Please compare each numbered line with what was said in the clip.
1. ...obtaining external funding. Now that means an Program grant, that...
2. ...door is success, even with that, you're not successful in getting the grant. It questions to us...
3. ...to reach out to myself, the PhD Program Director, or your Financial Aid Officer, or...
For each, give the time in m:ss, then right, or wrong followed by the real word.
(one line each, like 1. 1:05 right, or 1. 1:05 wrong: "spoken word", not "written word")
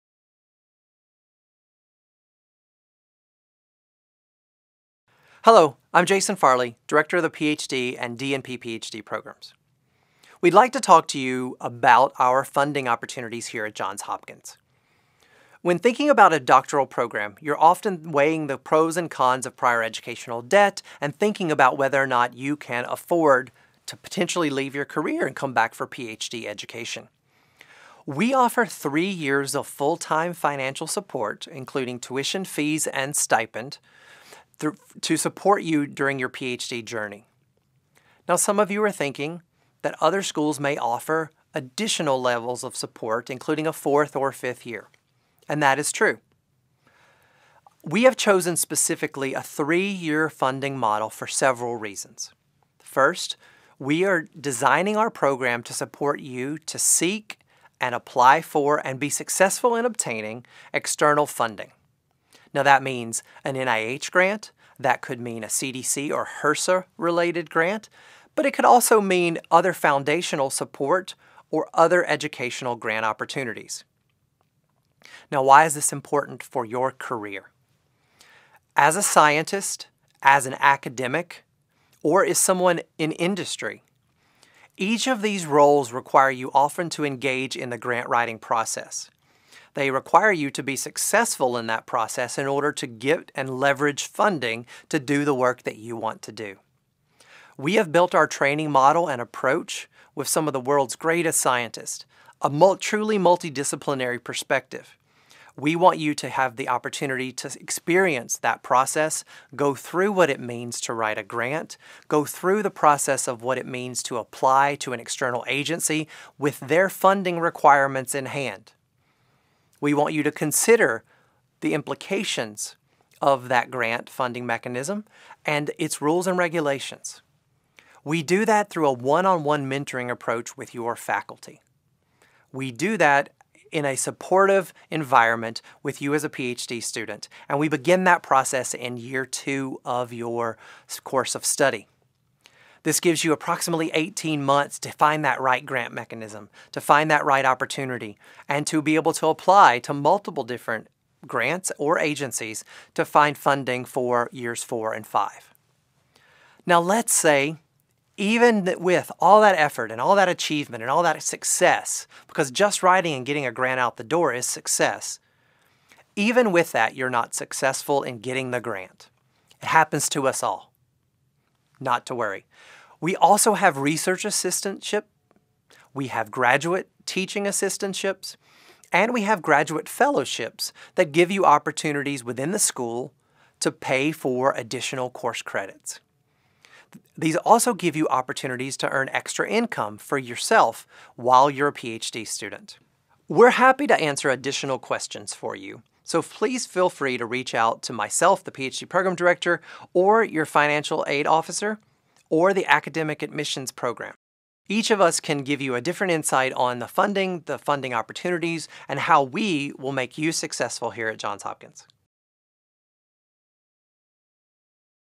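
1. 0:59 wrong: "NIH", not "Program"
2. 2:44 wrong: "happens", not "questions"
3. 3:17 right.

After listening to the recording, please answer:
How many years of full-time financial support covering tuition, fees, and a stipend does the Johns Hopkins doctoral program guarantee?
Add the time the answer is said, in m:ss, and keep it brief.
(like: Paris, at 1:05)
3, at 0:28.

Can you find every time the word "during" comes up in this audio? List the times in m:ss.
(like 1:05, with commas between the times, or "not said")
0:35.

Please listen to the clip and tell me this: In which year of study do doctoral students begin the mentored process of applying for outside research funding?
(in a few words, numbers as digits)
year two.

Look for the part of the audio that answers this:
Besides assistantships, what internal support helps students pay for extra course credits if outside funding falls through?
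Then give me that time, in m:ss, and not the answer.
2:59.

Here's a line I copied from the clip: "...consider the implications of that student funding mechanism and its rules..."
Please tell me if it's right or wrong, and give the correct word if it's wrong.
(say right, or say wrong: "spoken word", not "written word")
wrong: "grant", not "student".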